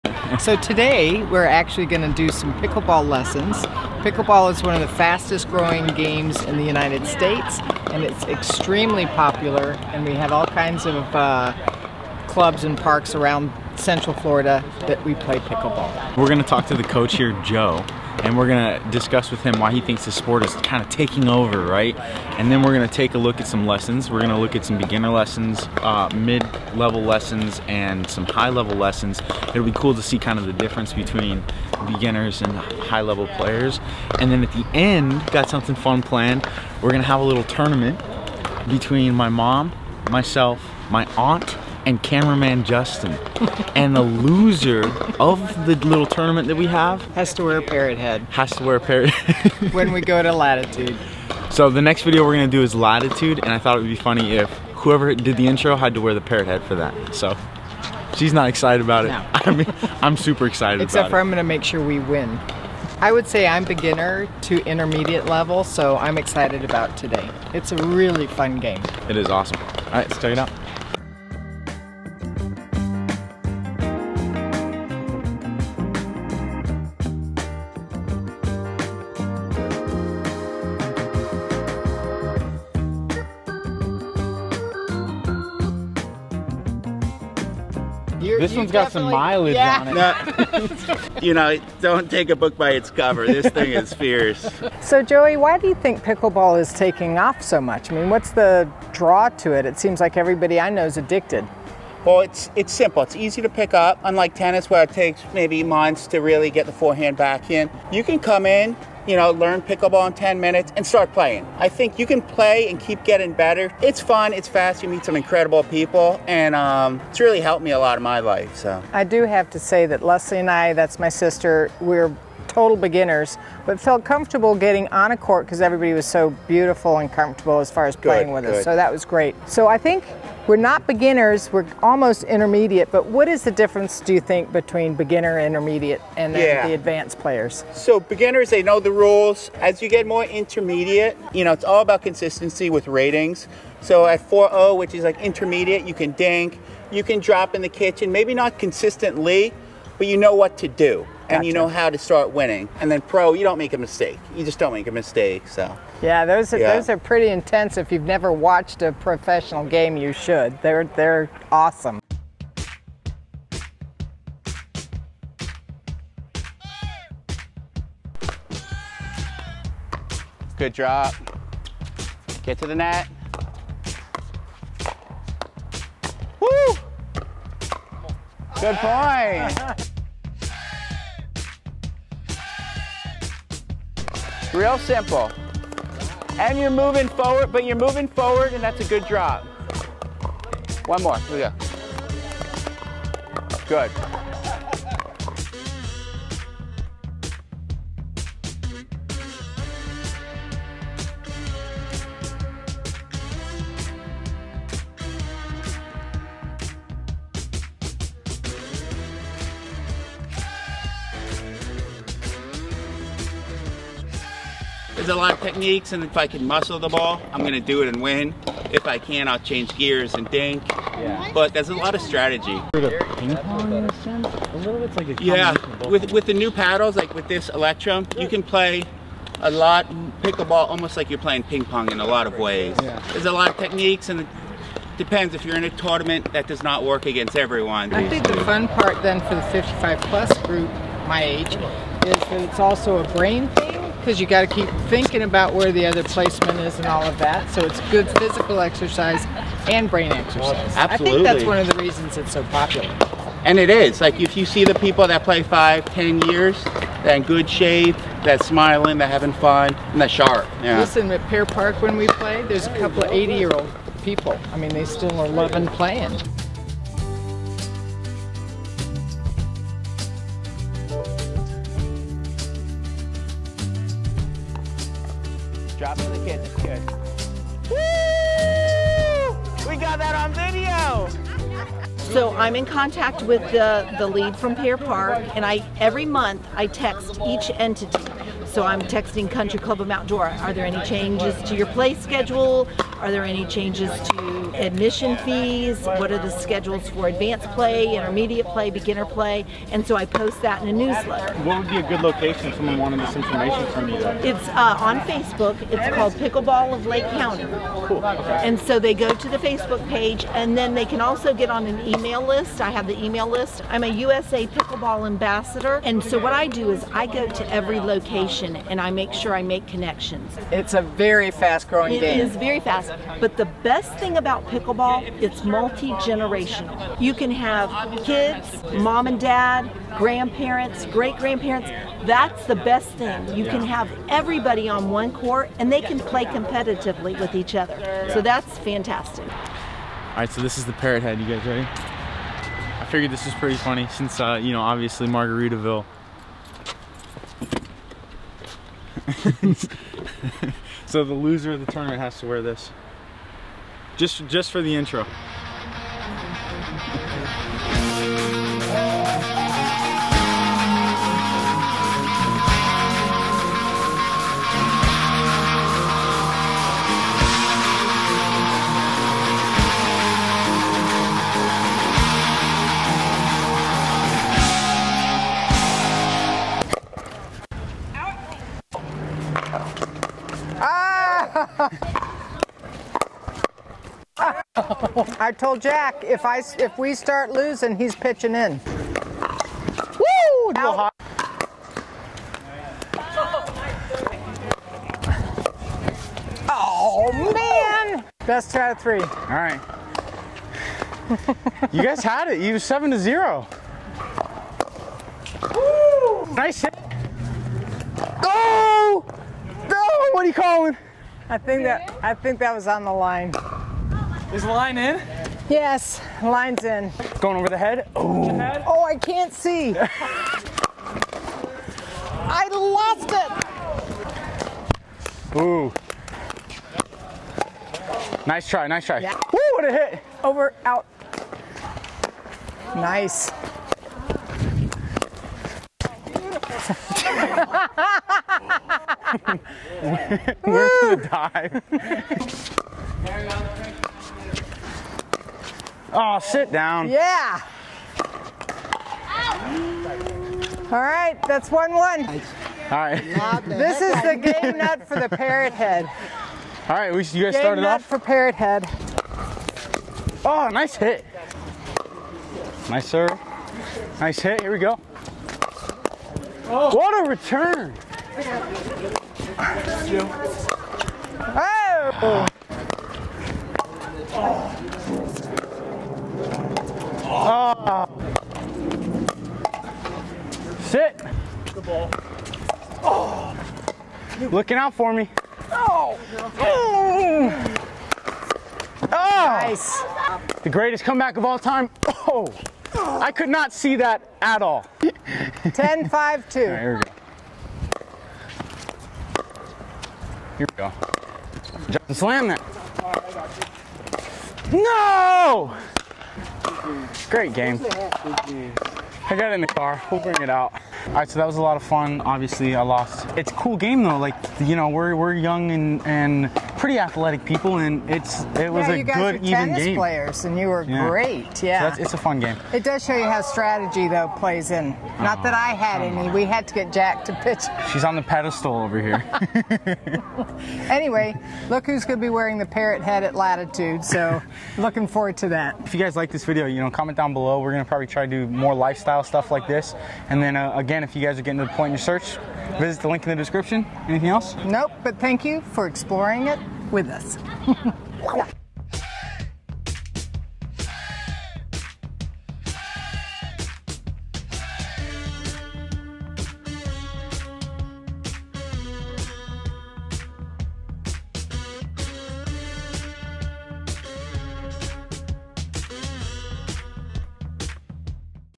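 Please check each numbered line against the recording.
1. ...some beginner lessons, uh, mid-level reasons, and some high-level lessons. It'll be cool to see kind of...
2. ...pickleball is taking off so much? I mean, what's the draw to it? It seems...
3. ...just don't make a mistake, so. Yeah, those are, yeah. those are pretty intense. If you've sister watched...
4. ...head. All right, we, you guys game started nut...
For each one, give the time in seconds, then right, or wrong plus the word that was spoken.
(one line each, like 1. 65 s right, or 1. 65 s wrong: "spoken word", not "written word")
1. 24 s wrong: "lessons", not "reasons"
2. 96 s right
3. 154 s wrong: "never", not "sister"
4. 455 s right.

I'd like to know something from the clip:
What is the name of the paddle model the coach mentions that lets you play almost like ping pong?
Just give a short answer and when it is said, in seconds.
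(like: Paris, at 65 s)
Electrum, at 227 s.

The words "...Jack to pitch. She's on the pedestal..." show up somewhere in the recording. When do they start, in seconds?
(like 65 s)
526 s.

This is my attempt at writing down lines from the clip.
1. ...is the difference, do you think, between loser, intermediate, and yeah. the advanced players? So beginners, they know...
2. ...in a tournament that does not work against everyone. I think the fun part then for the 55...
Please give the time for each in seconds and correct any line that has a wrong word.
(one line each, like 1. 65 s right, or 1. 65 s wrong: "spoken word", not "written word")
1. 133 s wrong: "beginner", not "loser"
2. 235 s right.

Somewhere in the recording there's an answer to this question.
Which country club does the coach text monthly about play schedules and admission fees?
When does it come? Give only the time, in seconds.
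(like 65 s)
289 s.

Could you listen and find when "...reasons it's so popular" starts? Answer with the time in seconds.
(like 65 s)
251 s.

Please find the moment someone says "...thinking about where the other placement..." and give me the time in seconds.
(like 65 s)
244 s.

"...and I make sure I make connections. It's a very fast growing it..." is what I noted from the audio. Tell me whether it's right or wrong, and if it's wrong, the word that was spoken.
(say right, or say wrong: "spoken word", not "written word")
right.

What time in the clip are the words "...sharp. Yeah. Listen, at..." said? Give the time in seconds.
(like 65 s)
260 s.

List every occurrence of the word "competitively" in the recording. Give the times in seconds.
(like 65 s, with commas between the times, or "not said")
336 s.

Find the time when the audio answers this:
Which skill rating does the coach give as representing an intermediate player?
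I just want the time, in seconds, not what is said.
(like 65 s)
144 s.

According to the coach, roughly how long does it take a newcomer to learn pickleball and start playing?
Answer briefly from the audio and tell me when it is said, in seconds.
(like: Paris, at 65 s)
10 minutes, at 110 s.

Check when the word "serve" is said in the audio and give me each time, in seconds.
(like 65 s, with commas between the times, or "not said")
462 s.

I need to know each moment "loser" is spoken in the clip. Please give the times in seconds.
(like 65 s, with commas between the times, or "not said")
44 s, 351 s.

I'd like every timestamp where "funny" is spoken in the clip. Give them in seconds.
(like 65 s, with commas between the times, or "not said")
53 s, 343 s.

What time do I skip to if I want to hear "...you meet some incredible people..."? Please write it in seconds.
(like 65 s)
114 s.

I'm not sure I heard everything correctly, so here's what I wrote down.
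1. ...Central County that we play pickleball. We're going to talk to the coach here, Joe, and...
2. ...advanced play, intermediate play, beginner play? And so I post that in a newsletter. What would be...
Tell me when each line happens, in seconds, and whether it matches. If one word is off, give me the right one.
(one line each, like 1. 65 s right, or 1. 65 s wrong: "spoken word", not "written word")
1. 13 s wrong: "Florida", not "County"
2. 297 s right.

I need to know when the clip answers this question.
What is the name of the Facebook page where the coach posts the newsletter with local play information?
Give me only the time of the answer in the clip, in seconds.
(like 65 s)
306 s.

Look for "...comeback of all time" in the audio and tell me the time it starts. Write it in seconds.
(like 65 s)
490 s.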